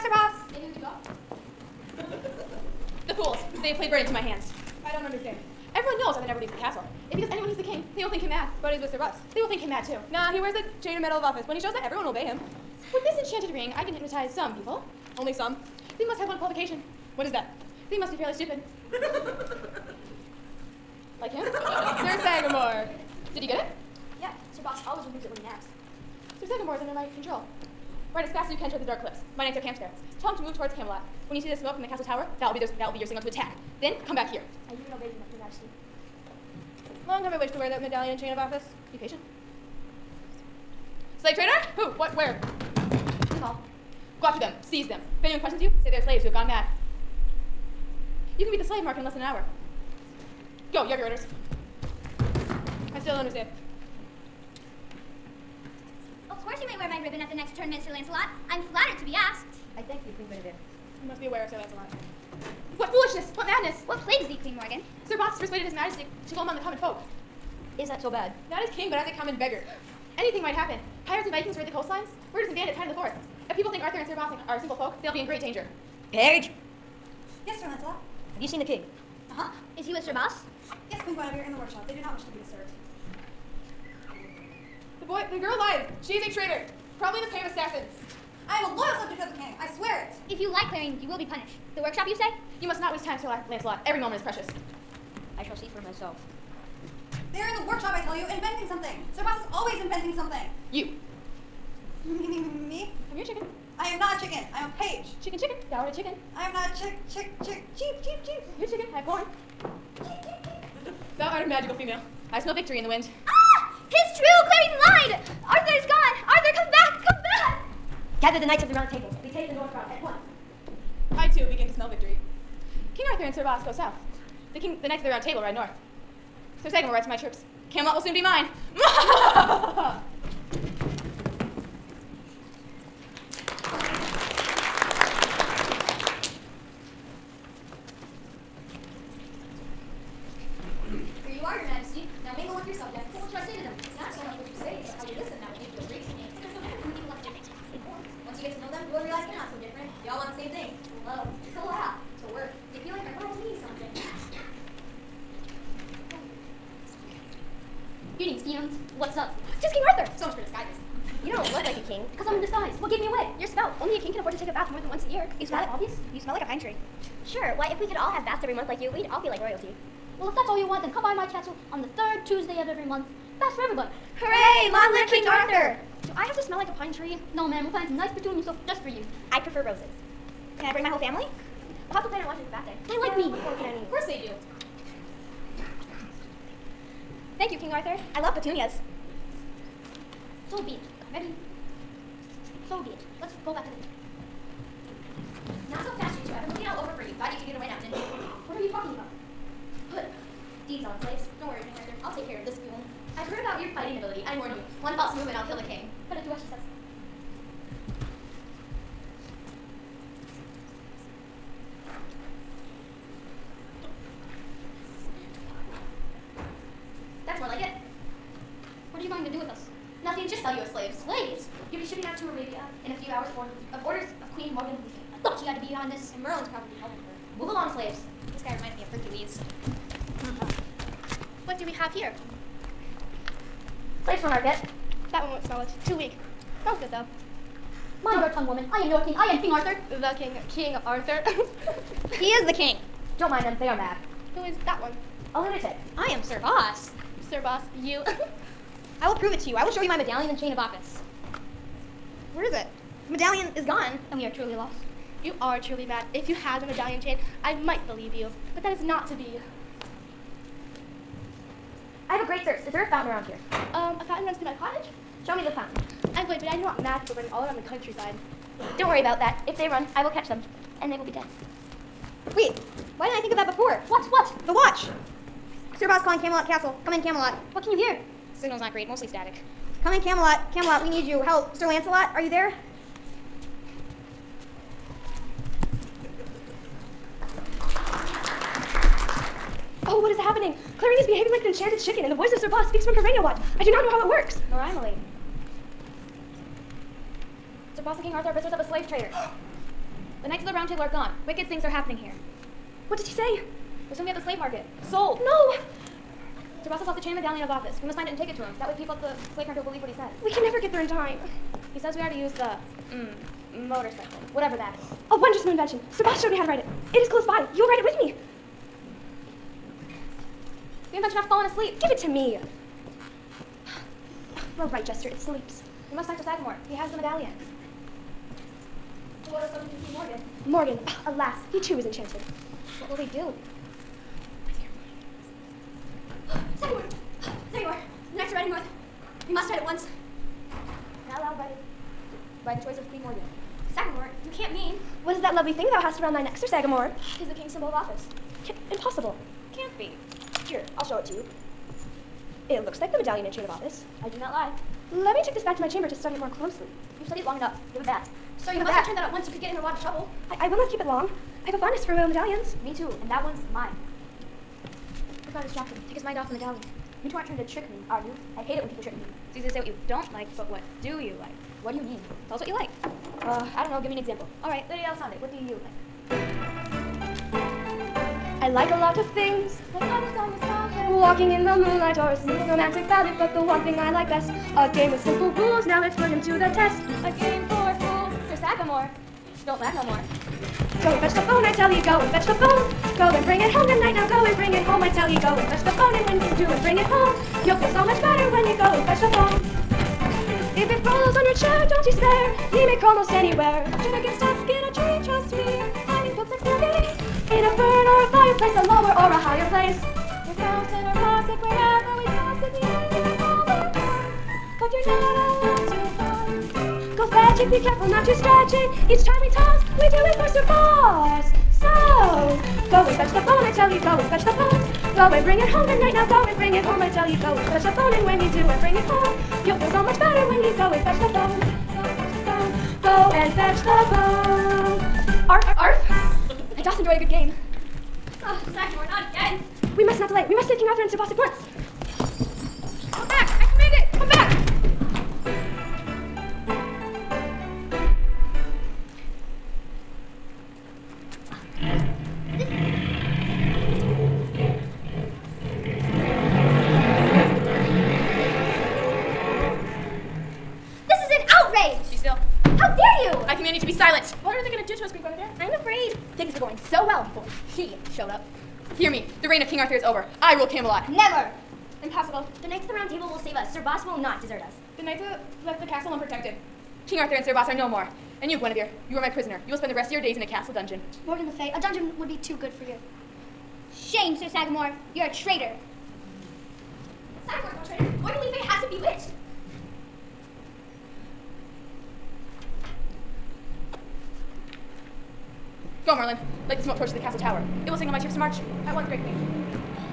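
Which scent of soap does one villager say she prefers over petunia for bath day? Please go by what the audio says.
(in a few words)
roses.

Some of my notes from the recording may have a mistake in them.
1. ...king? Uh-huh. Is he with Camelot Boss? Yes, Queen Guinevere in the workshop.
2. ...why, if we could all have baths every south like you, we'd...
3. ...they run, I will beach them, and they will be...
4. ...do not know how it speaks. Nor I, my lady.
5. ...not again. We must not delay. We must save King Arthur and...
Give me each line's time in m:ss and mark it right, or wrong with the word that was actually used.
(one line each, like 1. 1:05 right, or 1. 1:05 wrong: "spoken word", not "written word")
1. 1:18 wrong: "Sir", not "Camelot"
2. 2:47 wrong: "month", not "south"
3. 4:29 wrong: "catch", not "beach"
4. 4:53 wrong: "works", not "speaks"
5. 7:18 right.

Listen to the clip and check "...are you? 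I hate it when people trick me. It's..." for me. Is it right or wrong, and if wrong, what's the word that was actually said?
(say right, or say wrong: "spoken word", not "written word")
right.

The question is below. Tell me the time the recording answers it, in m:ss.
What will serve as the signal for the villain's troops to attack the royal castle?
0:31.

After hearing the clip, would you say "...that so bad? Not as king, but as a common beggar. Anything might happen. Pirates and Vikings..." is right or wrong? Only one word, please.
right.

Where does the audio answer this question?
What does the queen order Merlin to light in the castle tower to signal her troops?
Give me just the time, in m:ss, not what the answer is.
8:16.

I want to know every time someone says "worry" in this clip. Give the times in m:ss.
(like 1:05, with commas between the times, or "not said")
3:21, 4:28.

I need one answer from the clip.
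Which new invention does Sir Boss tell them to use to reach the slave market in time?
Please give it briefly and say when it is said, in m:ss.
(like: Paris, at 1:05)
motorcycle, at 5:13.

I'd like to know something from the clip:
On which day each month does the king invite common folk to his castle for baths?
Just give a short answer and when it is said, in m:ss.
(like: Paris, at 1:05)
third Tuesday, at 2:51.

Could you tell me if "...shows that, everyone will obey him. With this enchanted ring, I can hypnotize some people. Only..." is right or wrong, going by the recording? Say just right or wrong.
right.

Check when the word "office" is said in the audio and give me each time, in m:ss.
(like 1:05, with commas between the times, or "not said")
0:11, 0:38, 4:10, 5:07, 5:47, 5:53.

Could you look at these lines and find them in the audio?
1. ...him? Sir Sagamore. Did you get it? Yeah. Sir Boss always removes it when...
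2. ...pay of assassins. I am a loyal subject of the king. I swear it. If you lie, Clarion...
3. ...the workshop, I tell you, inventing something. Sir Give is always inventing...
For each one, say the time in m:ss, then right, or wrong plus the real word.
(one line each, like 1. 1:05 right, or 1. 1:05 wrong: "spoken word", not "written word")
1. 0:21 right
2. 1:27 right
3. 1:37 wrong: "Boss", not "Give".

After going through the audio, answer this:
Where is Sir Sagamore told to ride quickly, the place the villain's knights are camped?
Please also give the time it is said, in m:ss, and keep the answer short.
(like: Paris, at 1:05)
the dark cliffs, at 0:28.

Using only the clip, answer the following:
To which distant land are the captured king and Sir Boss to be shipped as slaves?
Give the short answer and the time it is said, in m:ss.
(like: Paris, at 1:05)
Arabia, at 3:42.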